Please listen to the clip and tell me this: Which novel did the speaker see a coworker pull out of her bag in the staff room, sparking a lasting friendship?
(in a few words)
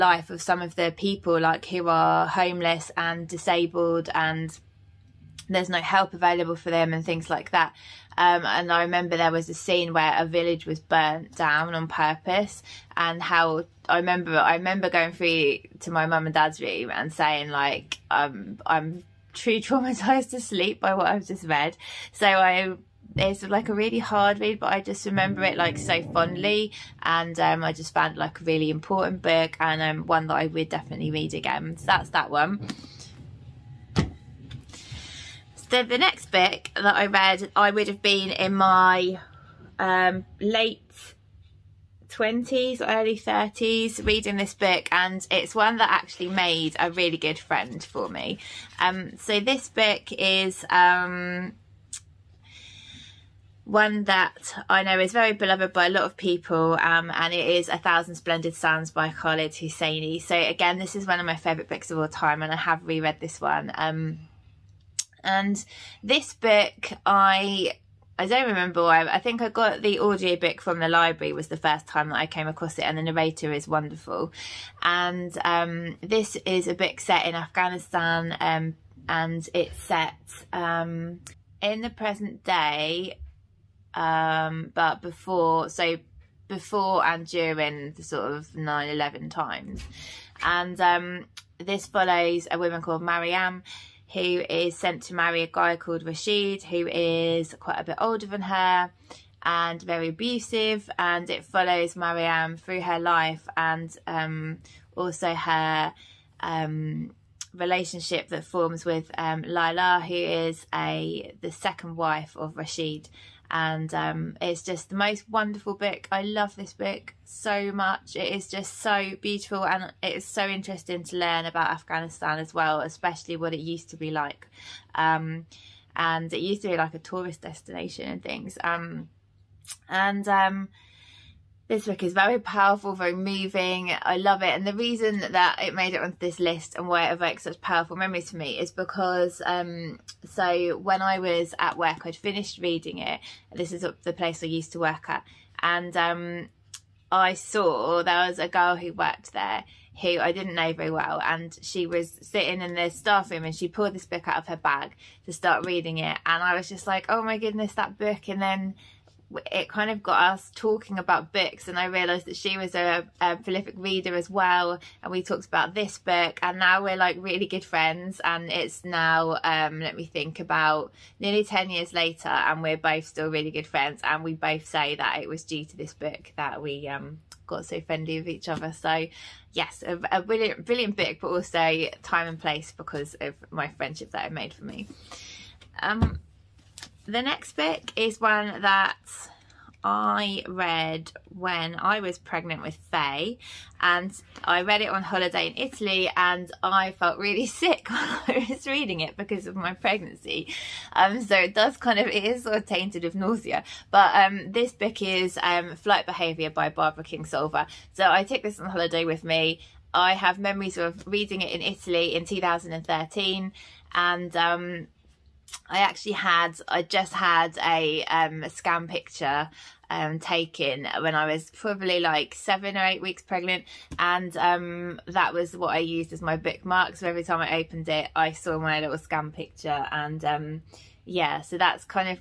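A Thousand Splendid Suns.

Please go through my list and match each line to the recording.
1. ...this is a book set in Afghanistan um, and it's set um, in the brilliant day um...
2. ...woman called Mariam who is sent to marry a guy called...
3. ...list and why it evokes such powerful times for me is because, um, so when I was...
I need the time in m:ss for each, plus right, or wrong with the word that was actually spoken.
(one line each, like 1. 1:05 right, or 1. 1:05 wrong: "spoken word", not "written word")
1. 1:15 wrong: "present", not "brilliant"
2. 1:32 right
3. 2:16 wrong: "memories", not "times".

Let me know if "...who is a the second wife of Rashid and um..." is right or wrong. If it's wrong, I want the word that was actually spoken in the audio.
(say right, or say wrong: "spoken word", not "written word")
right.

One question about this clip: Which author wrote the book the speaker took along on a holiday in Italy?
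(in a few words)
Barbara Kingsolver.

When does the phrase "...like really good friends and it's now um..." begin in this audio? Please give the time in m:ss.
2:46.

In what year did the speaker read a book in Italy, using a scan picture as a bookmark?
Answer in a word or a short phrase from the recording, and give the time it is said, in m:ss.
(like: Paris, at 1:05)
2013, at 3:32.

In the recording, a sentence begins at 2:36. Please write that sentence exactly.
And I was just like, oh my goodness, that book.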